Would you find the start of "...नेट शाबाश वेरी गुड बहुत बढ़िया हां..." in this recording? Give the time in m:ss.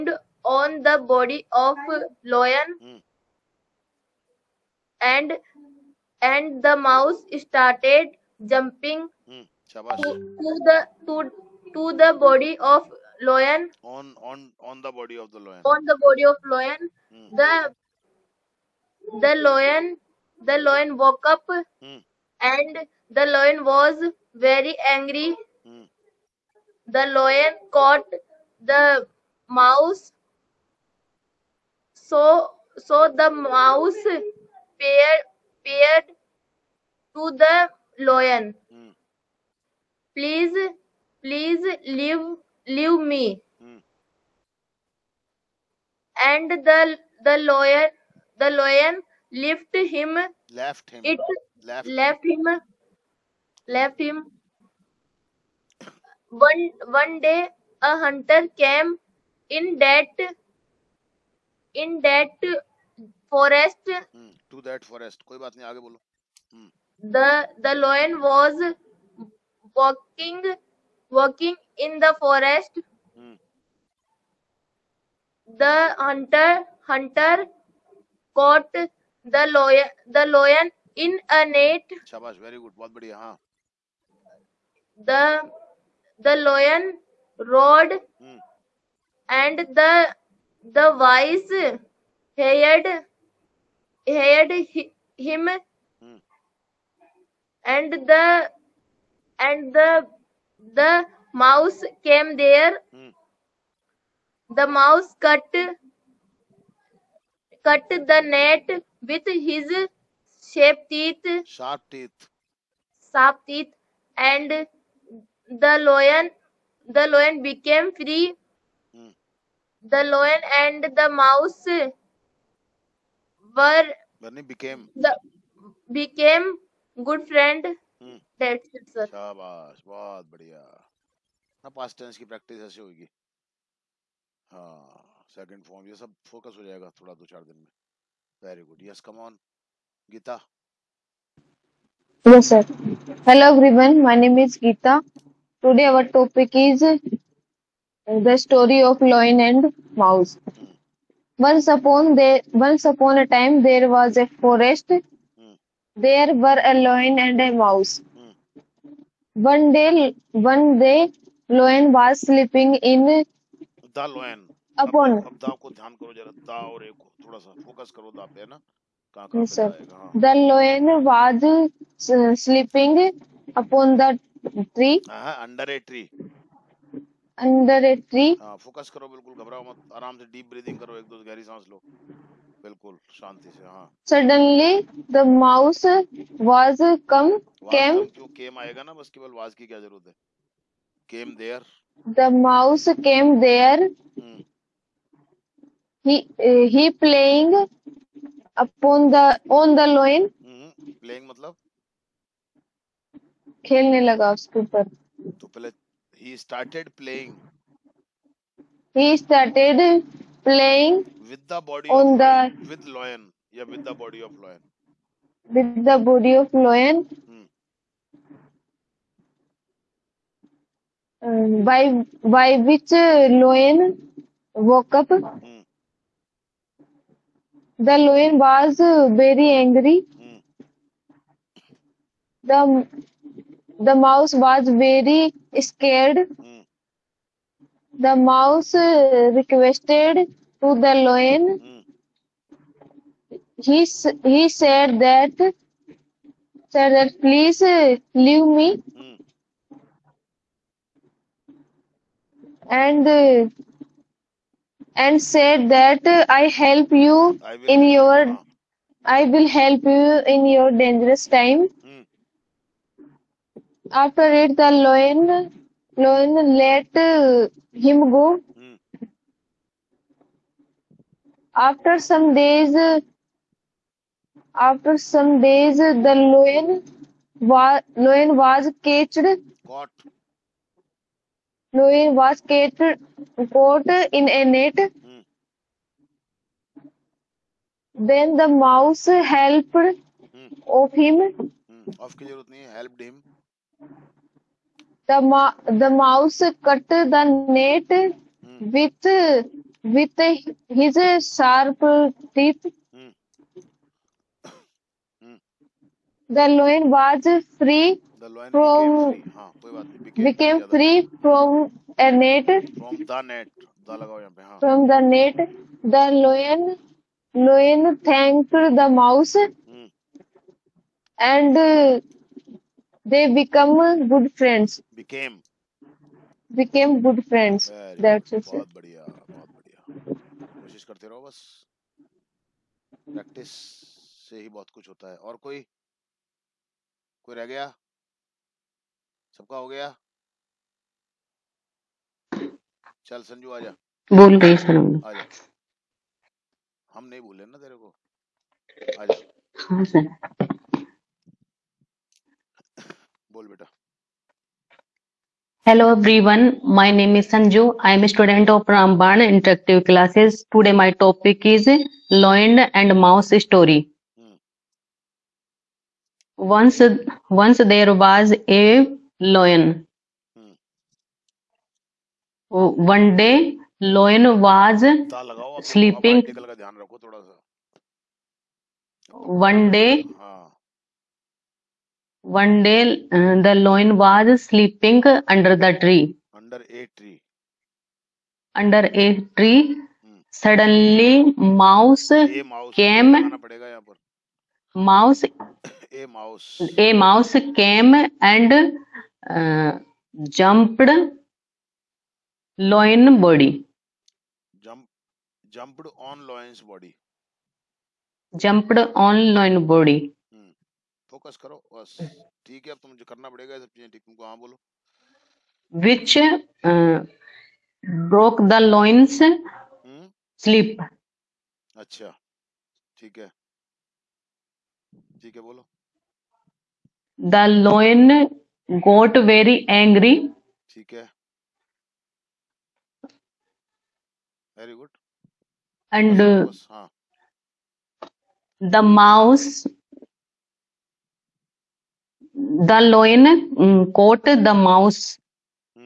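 1:21.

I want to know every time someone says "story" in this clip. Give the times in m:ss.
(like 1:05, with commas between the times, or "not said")
2:28, 6:03.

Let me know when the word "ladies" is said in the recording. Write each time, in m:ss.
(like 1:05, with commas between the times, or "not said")
not said.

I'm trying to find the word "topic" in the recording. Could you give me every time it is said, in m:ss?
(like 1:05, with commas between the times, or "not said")
2:26, 6:00.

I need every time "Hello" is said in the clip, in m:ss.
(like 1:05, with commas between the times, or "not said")
2:23, 5:55.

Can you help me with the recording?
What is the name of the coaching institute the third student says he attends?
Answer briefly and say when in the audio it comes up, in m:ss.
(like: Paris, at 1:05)
Ramban Interactive Classes, at 5:58.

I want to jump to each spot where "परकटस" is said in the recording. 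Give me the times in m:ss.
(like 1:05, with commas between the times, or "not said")
5:33.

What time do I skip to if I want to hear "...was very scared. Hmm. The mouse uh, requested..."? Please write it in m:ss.
3:54.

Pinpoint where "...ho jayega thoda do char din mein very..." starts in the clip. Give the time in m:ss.
2:16.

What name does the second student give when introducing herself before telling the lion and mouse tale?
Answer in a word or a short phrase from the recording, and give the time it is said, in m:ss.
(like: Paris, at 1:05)
Geeta, at 2:24.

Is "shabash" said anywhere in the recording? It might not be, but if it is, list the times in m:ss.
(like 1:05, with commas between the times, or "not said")
2:09.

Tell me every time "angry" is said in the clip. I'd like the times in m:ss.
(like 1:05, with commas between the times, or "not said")
0:24, 3:49.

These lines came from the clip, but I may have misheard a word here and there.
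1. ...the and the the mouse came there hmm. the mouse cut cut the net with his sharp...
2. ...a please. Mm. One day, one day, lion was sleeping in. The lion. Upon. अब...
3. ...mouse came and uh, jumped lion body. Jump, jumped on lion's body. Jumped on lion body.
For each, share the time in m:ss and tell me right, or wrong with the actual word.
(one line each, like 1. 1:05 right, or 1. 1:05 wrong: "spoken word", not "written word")
1. 1:38 right
2. 2:37 wrong: "mouse", not "please"
3. 6:36 right.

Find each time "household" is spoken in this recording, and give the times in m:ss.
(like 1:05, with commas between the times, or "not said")
not said.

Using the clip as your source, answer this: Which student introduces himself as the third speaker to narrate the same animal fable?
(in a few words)
Sanju.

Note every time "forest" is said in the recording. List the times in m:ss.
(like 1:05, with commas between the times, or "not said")
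1:03, 2:34.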